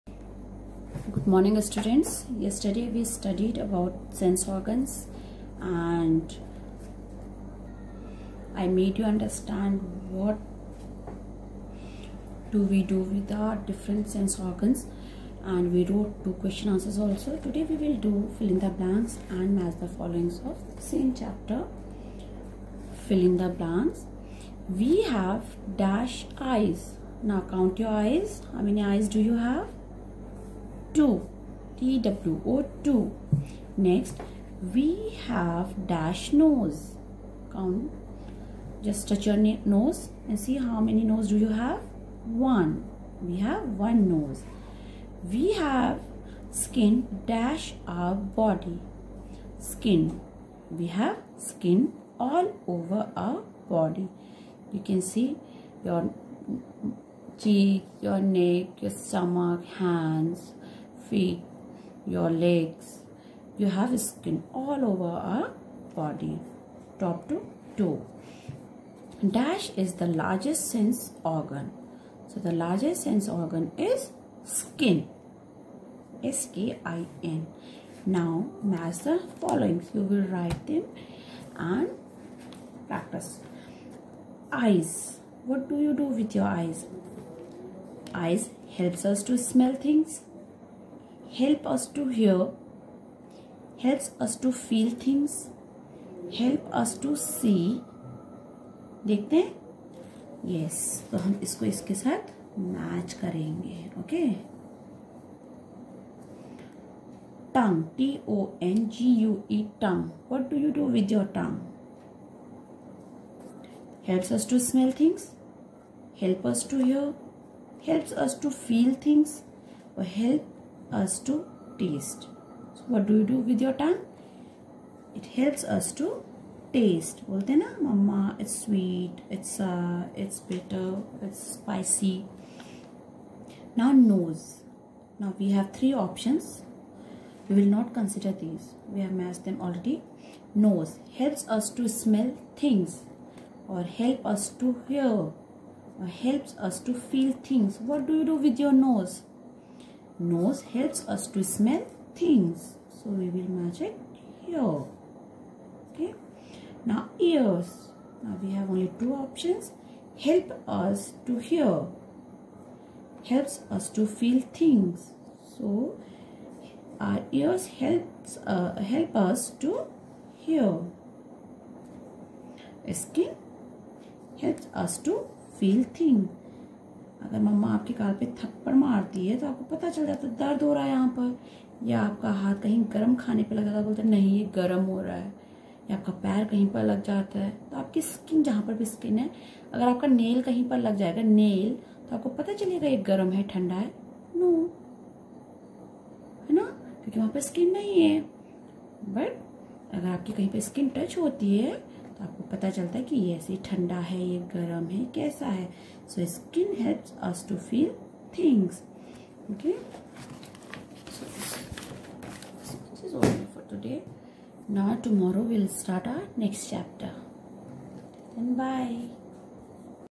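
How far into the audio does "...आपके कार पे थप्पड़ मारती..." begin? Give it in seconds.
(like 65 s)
177 s.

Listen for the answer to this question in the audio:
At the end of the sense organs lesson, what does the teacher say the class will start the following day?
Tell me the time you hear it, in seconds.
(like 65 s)
216 s.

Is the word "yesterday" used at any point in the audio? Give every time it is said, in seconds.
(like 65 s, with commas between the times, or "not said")
2 s.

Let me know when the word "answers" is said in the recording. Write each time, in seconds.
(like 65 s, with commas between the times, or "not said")
16 s.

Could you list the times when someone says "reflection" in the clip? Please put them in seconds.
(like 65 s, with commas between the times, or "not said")
not said.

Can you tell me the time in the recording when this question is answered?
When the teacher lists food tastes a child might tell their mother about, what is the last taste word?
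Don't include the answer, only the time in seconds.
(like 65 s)
131 s.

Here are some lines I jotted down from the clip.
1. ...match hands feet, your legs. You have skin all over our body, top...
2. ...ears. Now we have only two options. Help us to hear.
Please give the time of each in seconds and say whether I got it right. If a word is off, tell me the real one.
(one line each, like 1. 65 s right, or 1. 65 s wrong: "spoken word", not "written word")
1. 59 s wrong: "stomach", not "match"
2. 157 s right.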